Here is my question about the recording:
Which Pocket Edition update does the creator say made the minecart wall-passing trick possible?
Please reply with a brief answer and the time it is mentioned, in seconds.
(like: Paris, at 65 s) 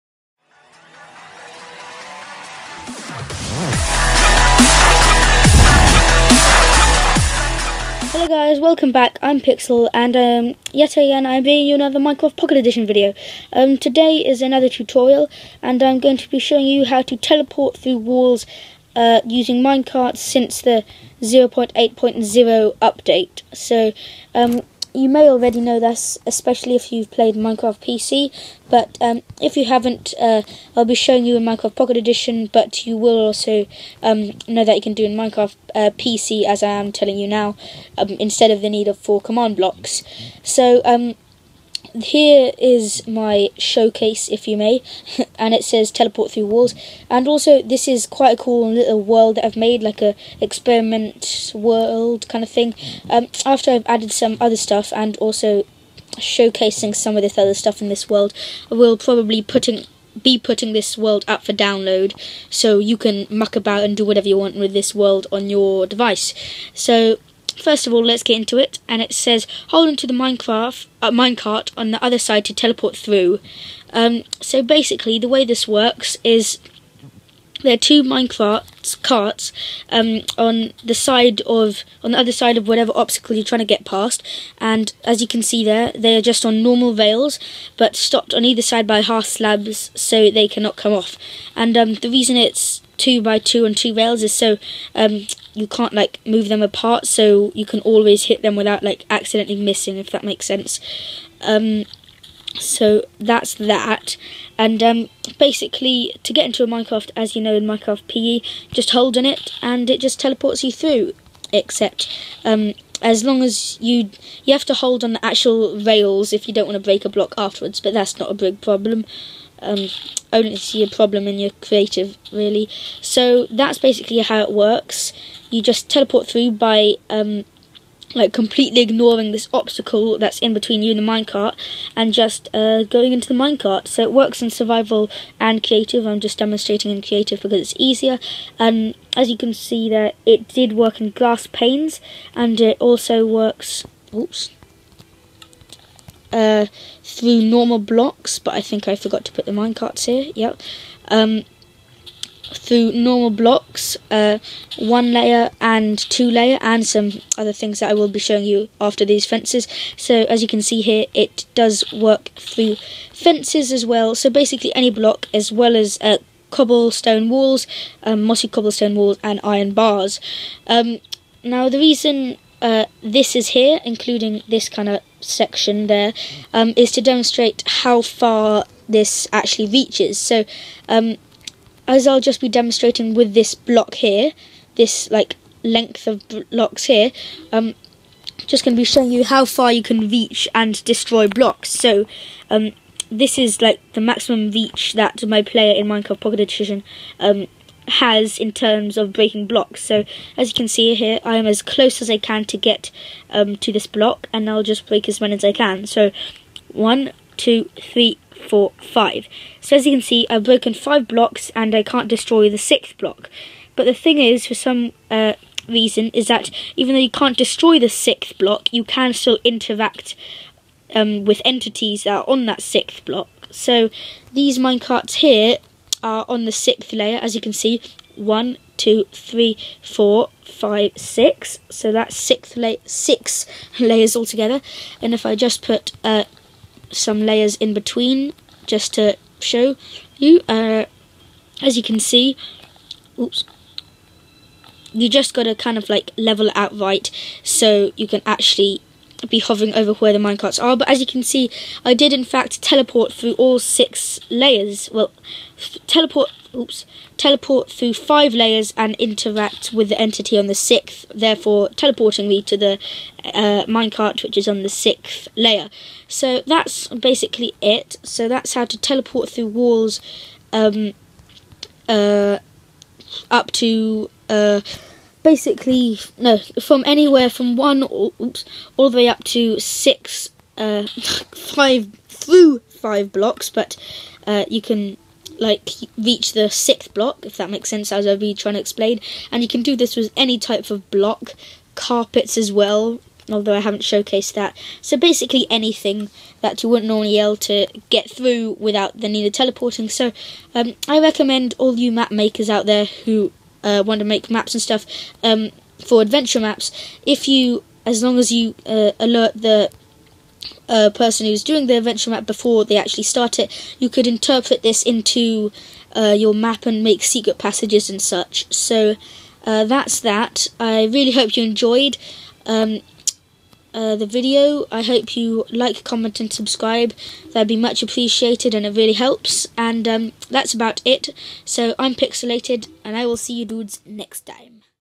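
0.8.0, at 21 s.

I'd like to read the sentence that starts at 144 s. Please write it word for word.
Oops uh, normal blocks, but I think I forgot to put the minecarts here.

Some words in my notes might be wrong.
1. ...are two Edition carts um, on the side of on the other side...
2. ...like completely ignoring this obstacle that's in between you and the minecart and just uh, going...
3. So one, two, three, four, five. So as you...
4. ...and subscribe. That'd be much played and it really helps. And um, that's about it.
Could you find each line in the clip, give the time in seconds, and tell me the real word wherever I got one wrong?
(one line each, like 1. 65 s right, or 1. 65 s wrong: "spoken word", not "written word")
1. 77 s wrong: "Minecraft", not "Edition"
2. 128 s right
3. 205 s right
4. 326 s wrong: "appreciated", not "played".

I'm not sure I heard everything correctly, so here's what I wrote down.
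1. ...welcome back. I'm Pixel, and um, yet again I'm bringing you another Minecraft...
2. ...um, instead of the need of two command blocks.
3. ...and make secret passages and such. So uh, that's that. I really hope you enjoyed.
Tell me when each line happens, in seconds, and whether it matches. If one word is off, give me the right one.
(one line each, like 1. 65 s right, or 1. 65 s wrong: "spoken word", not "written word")
1. 8 s right
2. 37 s wrong: "four", not "two"
3. 316 s right.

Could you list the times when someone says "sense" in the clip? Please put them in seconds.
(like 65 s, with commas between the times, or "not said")
100 s, 287 s.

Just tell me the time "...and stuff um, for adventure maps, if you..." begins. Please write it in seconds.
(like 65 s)
304 s.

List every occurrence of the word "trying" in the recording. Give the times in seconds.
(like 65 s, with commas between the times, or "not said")
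83 s, 288 s.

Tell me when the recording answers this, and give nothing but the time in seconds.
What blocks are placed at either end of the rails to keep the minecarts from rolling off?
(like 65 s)
89 s.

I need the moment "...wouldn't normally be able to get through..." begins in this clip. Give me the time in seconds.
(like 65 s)
296 s.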